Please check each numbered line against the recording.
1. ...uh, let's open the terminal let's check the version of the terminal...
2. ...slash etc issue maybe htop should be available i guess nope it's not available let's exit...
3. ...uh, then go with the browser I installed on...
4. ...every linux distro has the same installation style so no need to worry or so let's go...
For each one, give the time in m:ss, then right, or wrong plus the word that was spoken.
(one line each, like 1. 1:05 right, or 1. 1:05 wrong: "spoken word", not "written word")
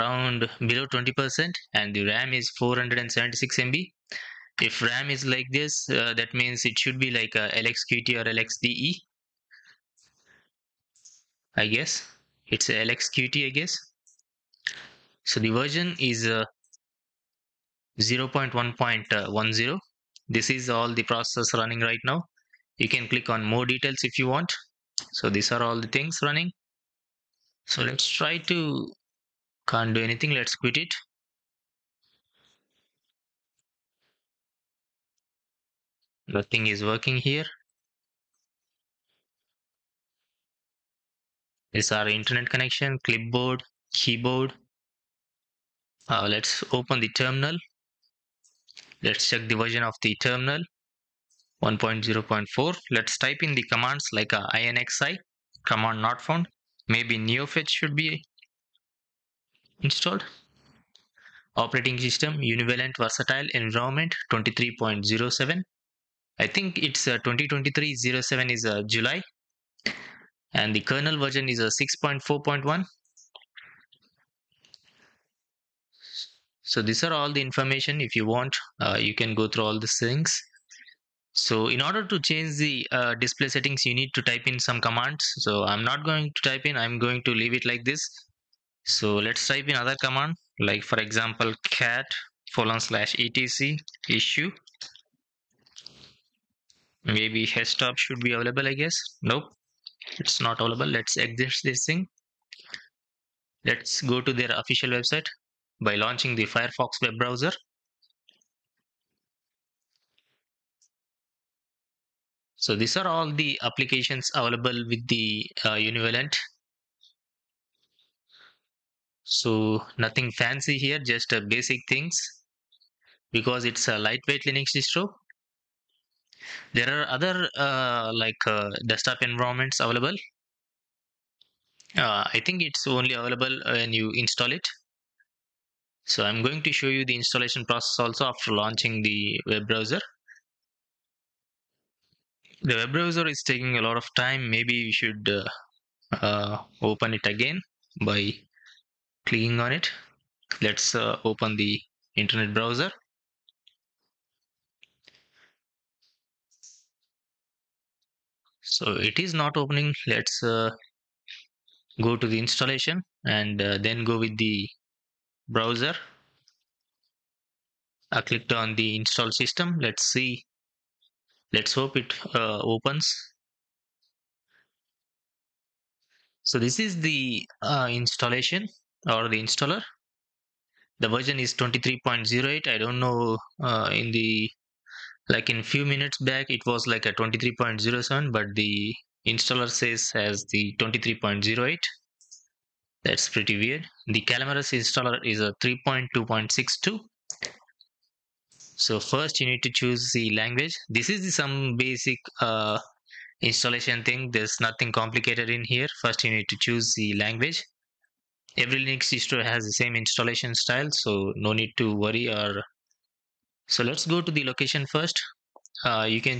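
1. 0:46 right
2. 1:32 right
3. 2:43 wrong: "clicked", not "installed"
4. 3:28 right.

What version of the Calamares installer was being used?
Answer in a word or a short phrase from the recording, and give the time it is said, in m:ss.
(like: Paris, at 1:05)
3.2.62, at 3:15.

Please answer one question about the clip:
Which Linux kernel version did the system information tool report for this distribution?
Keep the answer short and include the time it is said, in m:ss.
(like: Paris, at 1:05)
6.4.1, at 1:11.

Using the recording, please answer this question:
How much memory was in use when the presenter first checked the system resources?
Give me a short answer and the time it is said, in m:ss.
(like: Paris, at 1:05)
476 MB, at 0:02.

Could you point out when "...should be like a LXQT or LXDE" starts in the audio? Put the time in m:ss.
0:06.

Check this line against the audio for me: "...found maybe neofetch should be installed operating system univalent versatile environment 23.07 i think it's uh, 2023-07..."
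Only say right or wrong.
right.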